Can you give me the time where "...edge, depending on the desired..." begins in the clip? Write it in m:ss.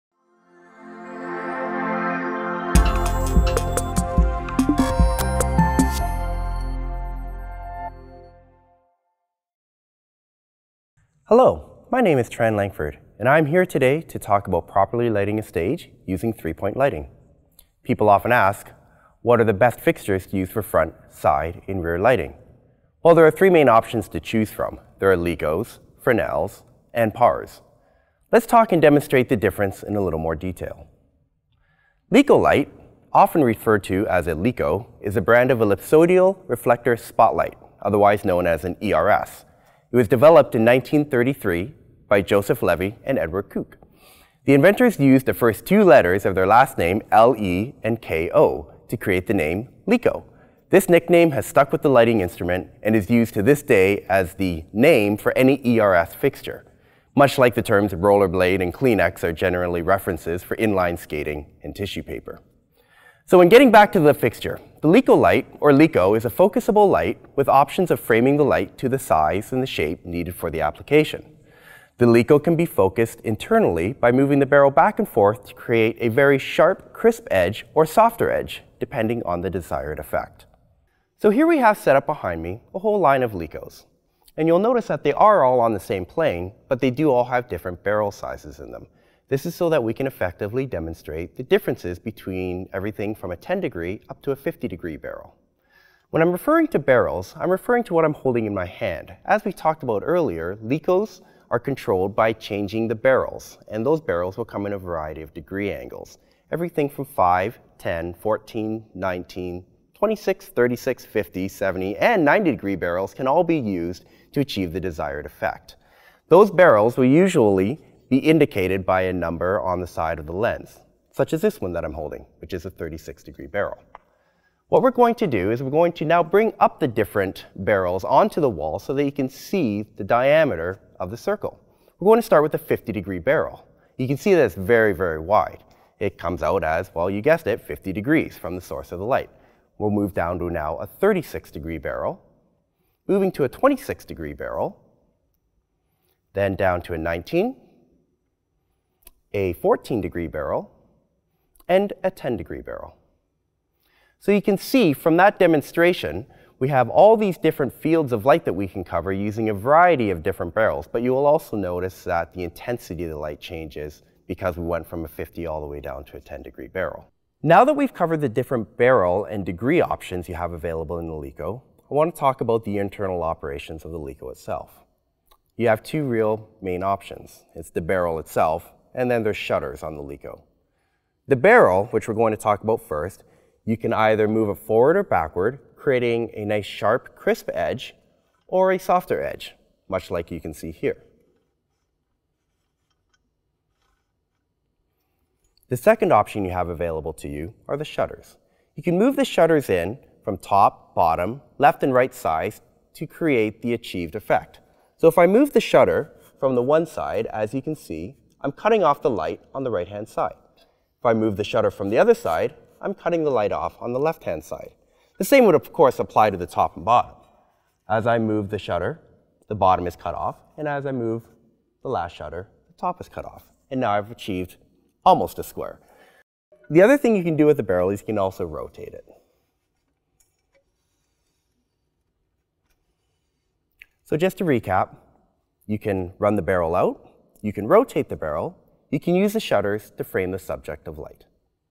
1:18.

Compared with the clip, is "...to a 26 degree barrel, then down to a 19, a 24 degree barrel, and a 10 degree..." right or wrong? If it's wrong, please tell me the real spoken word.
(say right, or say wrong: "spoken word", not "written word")
wrong: "14", not "24".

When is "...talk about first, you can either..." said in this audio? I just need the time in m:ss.
3:02.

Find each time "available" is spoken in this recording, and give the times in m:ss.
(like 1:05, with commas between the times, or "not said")
2:50, 3:16.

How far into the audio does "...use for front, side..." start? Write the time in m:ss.
0:20.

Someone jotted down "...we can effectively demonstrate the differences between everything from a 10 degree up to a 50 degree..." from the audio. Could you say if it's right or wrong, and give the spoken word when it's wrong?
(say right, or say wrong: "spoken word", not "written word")
right.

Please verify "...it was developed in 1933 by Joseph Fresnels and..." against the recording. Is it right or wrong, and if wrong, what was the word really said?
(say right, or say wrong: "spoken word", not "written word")
wrong: "Levy", not "Fresnels".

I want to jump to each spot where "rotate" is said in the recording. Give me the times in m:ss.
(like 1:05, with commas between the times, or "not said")
3:48, 3:57.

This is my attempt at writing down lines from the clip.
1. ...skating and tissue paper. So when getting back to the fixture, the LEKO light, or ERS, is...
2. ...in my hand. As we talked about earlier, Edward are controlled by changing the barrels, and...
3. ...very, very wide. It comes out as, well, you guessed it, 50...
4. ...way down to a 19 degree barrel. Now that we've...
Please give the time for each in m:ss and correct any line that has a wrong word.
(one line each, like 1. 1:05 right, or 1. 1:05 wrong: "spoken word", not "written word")
1. 1:00 wrong: "LEKO", not "ERS"
2. 1:38 wrong: "LEKOs", not "Edward"
3. 2:14 right
4. 2:45 wrong: "10", not "19".